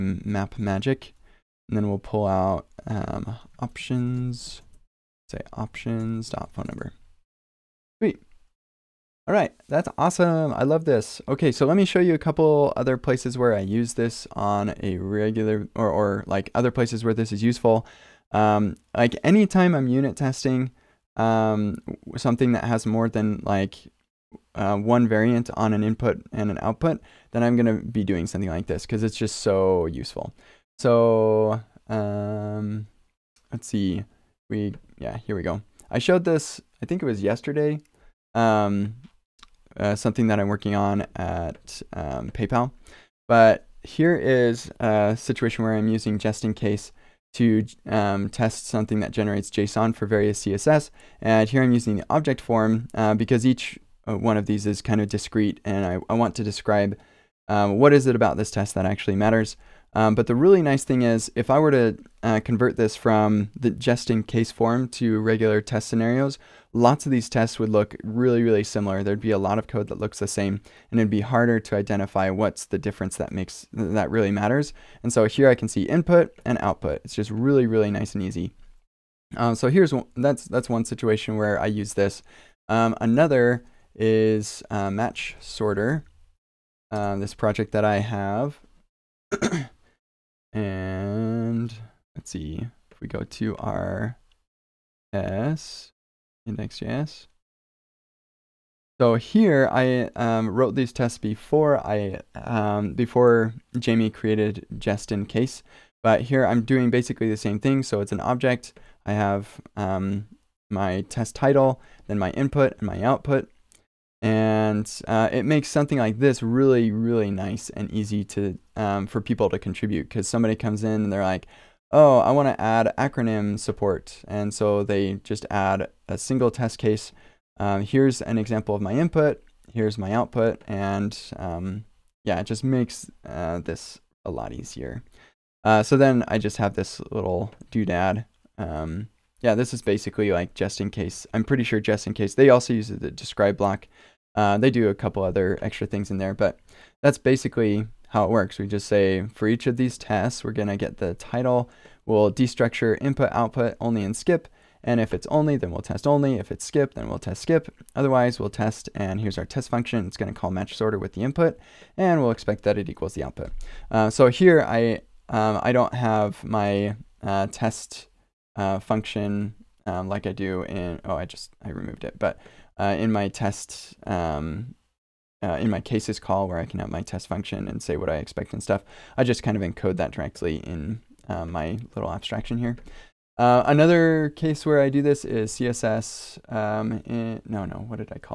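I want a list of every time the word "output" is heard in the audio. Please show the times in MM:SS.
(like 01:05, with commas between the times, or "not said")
00:26, 01:16, 01:53, 02:10, 02:33, 02:43.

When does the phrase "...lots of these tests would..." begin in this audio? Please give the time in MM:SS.
01:06.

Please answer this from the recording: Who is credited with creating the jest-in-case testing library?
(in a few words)
Jamie.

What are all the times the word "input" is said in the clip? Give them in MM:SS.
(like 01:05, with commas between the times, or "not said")
00:25, 01:15, 01:52, 02:08, 02:33, 02:41.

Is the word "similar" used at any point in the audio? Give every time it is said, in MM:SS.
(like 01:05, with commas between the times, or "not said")
01:08.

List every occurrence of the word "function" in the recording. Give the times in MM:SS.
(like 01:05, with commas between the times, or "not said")
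02:39, 02:48, 02:57.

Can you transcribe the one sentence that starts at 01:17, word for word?
It's just really, really nice and easy.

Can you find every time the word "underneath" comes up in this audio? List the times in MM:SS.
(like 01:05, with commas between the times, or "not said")
not said.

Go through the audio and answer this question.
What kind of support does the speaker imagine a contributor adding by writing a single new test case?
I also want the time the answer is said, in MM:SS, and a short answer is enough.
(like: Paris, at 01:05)
acronym support, at 02:02.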